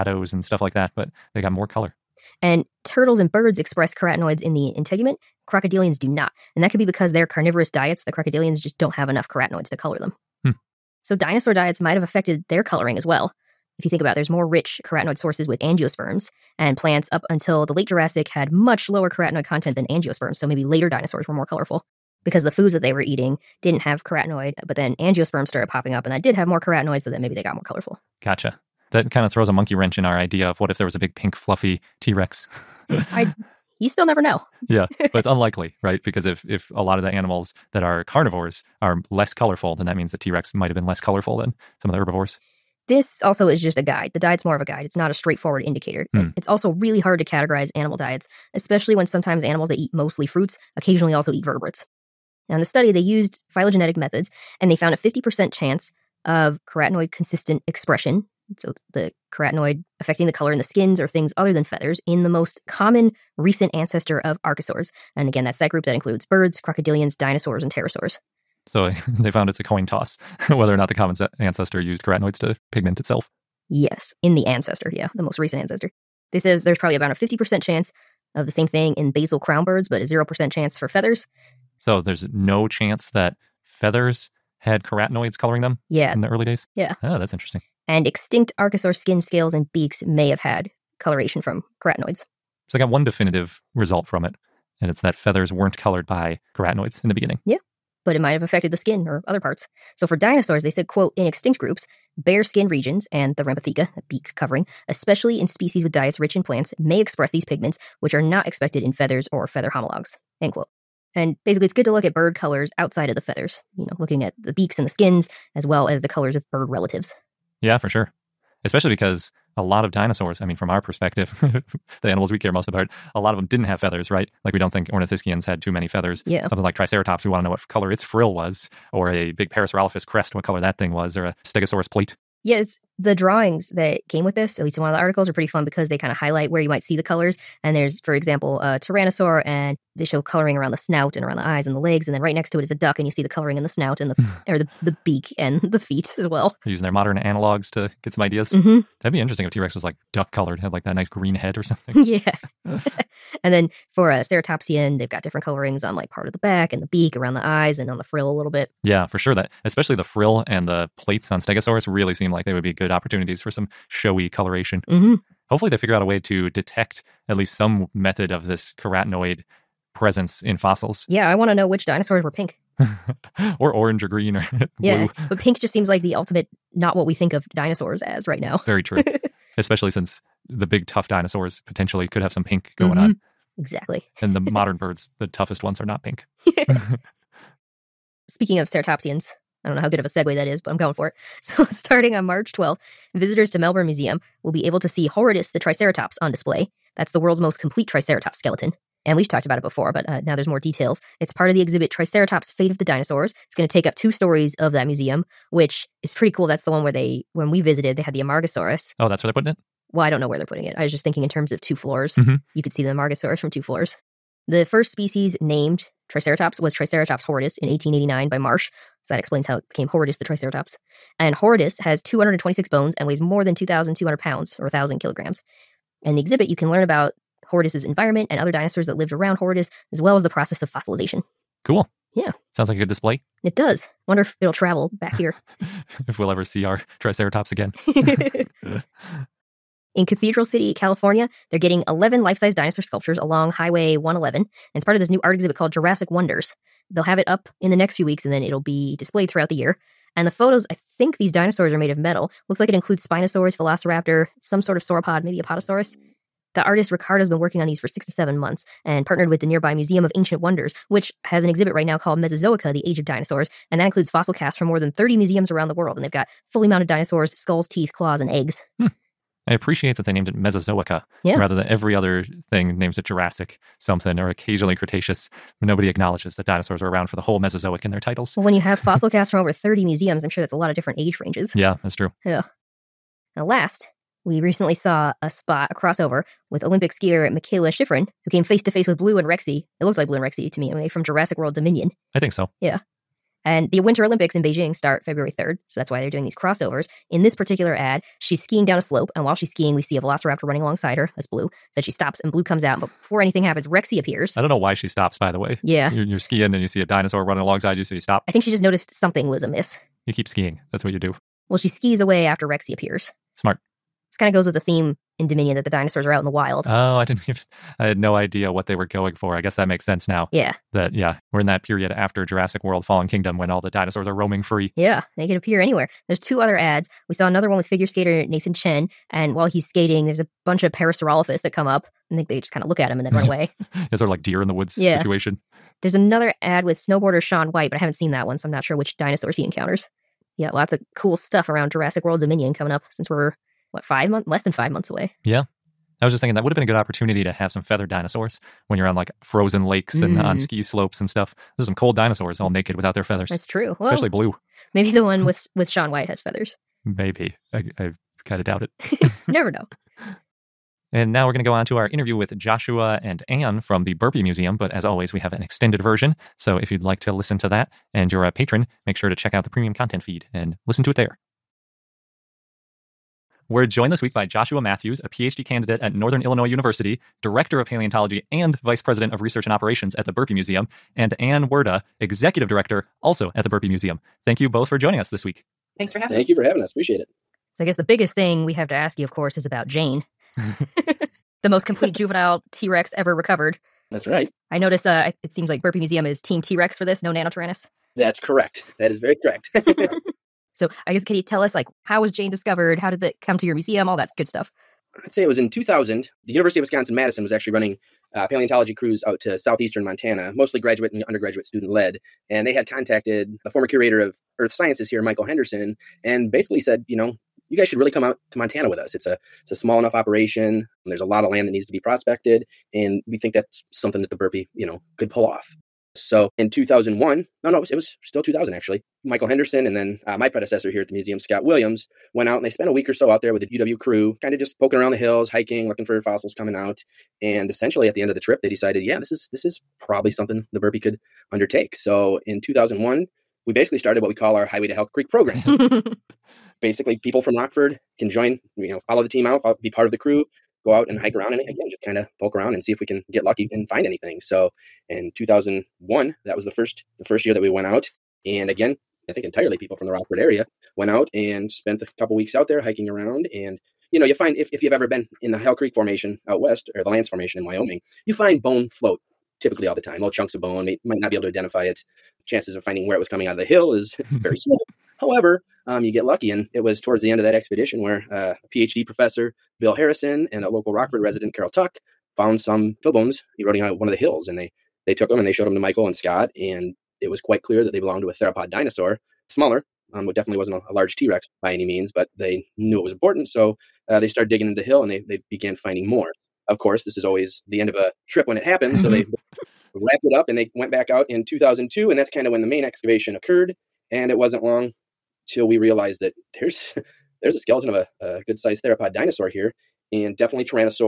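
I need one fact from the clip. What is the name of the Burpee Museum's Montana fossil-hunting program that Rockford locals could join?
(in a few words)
Highway to Hell Creek.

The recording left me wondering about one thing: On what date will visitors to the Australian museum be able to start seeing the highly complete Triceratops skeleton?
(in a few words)
March 12th.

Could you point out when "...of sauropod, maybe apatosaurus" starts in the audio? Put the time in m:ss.
4:14.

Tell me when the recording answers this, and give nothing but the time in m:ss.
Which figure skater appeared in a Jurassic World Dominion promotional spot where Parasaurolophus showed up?
5:28.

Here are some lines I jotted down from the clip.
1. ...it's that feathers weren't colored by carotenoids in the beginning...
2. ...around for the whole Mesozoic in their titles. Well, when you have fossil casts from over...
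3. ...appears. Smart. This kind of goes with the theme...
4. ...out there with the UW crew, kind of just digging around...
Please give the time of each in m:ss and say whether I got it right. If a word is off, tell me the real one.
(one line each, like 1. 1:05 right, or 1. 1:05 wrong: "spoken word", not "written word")
1. 1:34 right
2. 4:36 right
3. 5:12 right
4. 7:13 wrong: "poking", not "digging".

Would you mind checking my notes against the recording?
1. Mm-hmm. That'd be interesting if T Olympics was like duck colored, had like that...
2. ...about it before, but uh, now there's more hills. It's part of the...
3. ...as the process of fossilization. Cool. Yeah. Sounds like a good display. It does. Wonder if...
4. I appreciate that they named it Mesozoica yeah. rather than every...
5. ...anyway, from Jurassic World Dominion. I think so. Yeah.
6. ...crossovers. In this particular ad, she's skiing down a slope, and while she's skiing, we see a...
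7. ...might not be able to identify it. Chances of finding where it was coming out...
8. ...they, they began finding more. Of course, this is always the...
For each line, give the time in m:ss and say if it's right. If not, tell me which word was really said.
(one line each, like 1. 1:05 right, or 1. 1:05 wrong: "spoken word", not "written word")
1. 2:28 wrong: "Rex", not "Olympics"
2. 3:19 wrong: "details", not "hills"
3. 3:50 right
4. 4:29 right
5. 4:50 right
6. 4:56 right
7. 7:50 right
8. 8:14 right.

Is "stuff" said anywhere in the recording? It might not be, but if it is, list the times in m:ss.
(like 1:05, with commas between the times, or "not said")
0:00, 5:41, 5:51, 6:44.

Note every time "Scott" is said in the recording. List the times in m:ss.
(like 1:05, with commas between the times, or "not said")
7:11, 8:05.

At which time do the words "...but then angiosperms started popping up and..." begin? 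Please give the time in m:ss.
0:24.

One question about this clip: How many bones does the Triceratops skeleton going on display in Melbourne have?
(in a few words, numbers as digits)
226.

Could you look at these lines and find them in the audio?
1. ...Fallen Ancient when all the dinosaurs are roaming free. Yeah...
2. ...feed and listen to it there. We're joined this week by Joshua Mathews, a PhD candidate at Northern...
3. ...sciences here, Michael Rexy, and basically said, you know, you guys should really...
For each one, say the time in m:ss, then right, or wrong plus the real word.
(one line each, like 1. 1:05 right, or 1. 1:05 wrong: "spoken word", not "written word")
1. 5:22 wrong: "Kingdom", not "Ancient"
2. 6:10 right
3. 6:54 wrong: "Henderson", not "Rexy".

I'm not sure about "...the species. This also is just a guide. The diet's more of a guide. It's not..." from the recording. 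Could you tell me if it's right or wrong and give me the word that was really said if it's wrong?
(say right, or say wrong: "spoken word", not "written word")
wrong: "herbivores", not "species".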